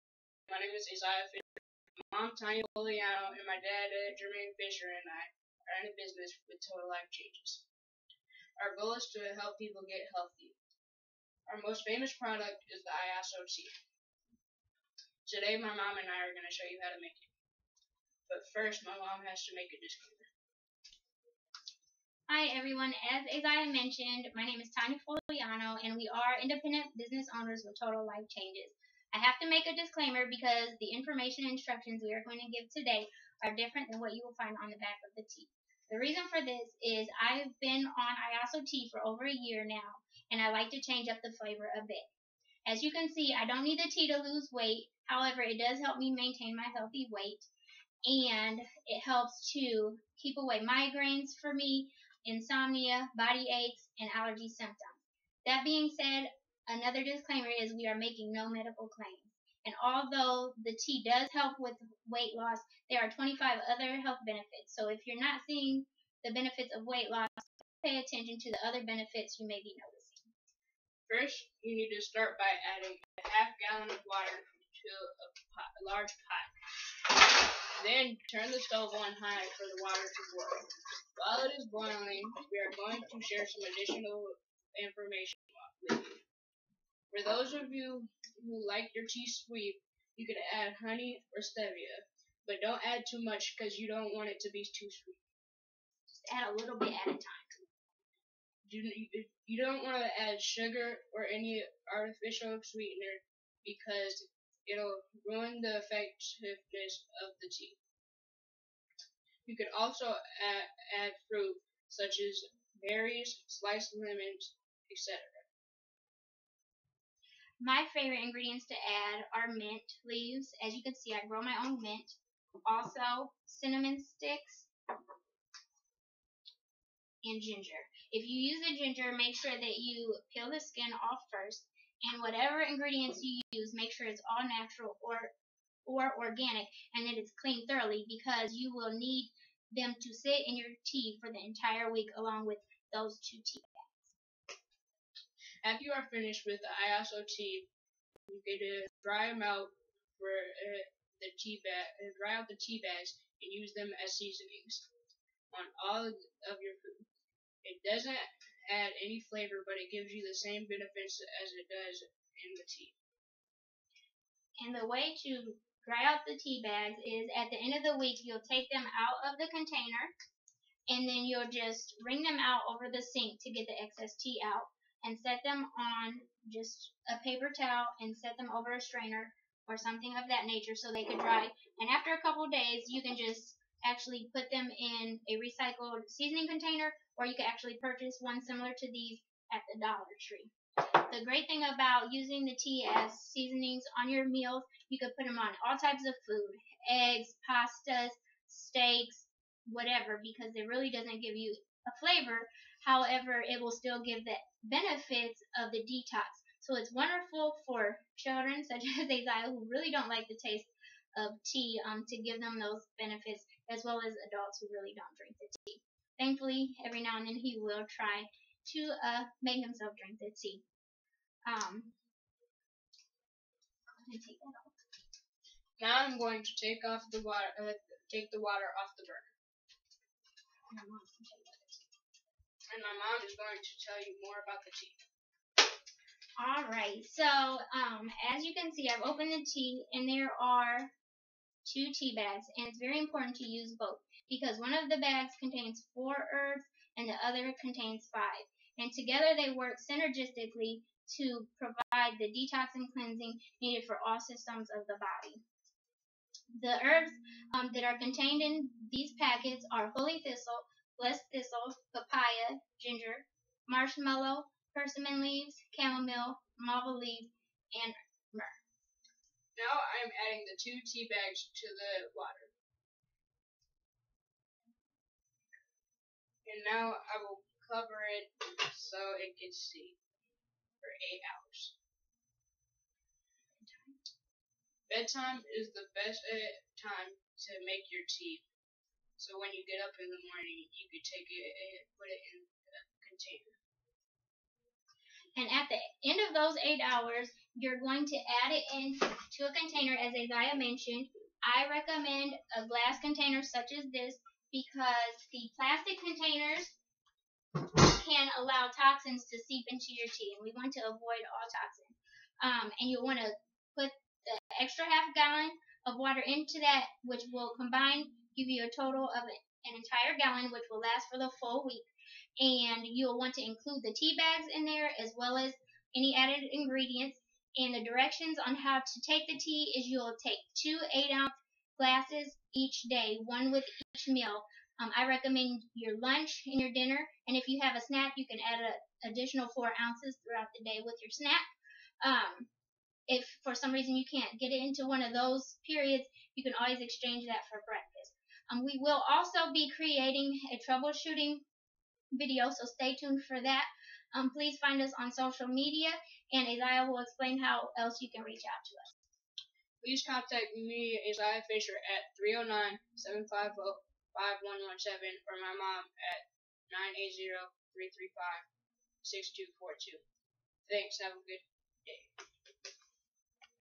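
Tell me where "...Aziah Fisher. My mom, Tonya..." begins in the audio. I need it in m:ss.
0:00.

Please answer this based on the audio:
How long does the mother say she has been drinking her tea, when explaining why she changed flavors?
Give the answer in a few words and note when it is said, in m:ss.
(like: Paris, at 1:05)
over a year, at 0:39.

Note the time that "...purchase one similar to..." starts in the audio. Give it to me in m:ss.
3:07.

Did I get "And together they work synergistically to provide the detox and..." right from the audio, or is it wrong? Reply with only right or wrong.
right.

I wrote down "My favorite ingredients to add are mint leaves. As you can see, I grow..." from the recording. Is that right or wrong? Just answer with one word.
right.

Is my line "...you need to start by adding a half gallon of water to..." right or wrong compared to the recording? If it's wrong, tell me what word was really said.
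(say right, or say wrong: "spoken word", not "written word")
right.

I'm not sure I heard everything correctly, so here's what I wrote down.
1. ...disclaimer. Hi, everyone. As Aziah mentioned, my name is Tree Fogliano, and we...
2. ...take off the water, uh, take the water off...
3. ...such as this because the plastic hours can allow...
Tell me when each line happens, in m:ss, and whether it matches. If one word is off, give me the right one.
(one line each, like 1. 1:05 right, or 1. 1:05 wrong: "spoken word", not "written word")
1. 0:19 wrong: "Tonya", not "Tree"
2. 3:46 right
3. 5:03 wrong: "containers", not "hours".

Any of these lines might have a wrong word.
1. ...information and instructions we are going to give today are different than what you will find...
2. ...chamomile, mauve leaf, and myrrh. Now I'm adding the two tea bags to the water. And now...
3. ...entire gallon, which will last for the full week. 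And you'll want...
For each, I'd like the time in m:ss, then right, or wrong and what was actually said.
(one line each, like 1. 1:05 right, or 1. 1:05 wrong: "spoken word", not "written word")
1. 0:30 right
2. 4:25 right
3. 5:19 right.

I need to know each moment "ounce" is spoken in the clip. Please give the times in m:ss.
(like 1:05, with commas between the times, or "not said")
5:31, 5:39.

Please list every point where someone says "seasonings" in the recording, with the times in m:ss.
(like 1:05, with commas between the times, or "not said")
2:34, 3:06, 3:13.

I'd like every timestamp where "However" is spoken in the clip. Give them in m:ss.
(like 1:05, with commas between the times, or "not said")
0:45, 3:22.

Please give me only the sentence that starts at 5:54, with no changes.
Um, please find us on social media, and Aziah will explain how else you can reach out to us.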